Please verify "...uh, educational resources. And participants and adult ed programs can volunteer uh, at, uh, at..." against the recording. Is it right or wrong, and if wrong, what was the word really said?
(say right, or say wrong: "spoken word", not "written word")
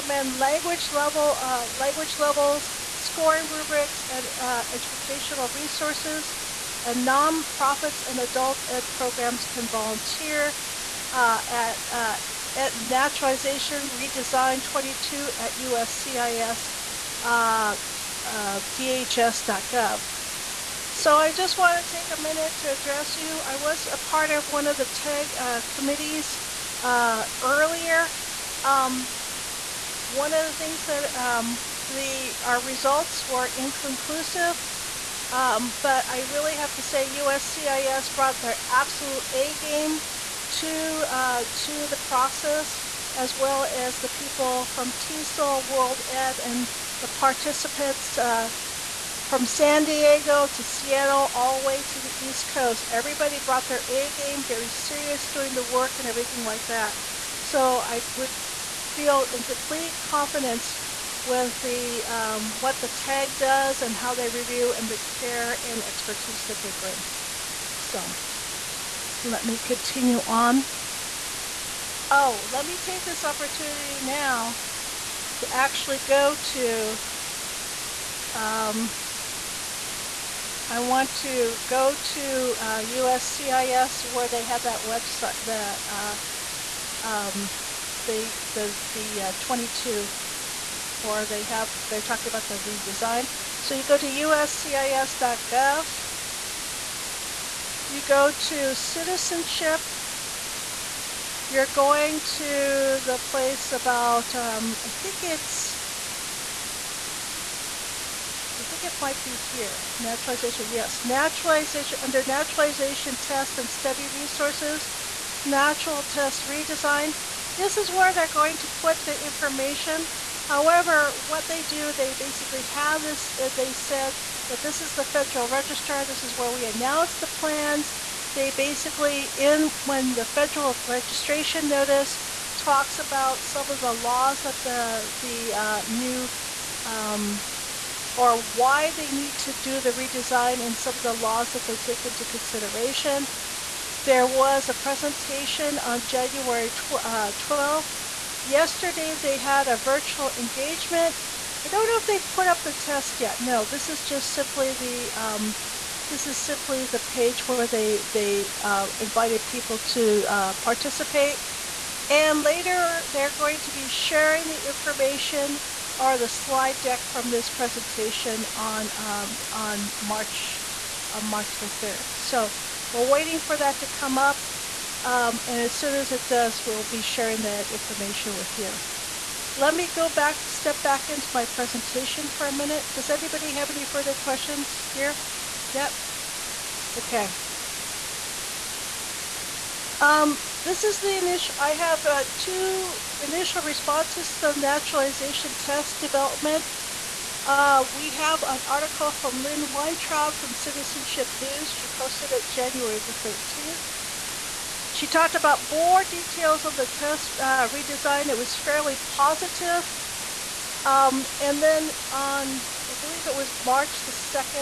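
wrong: "nonprofits", not "participants".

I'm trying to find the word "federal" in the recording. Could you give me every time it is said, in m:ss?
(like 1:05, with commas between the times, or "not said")
2:05, 2:10.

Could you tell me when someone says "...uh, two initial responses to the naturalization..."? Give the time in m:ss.
3:12.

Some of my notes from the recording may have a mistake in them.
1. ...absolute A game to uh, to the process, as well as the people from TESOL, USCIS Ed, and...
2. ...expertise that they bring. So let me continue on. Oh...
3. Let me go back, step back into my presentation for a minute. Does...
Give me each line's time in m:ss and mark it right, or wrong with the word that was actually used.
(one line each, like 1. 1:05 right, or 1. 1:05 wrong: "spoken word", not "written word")
1. 0:38 wrong: "World", not "USCIS"
2. 1:05 right
3. 2:59 right.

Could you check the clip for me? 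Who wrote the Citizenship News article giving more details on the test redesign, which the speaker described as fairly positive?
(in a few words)
Lynn Weintraub.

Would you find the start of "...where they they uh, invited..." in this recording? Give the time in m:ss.
2:37.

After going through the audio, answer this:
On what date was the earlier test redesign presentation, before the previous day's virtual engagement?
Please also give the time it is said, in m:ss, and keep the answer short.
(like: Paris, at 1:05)
January 12, at 2:26.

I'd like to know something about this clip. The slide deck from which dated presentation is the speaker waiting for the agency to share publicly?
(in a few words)
March 3.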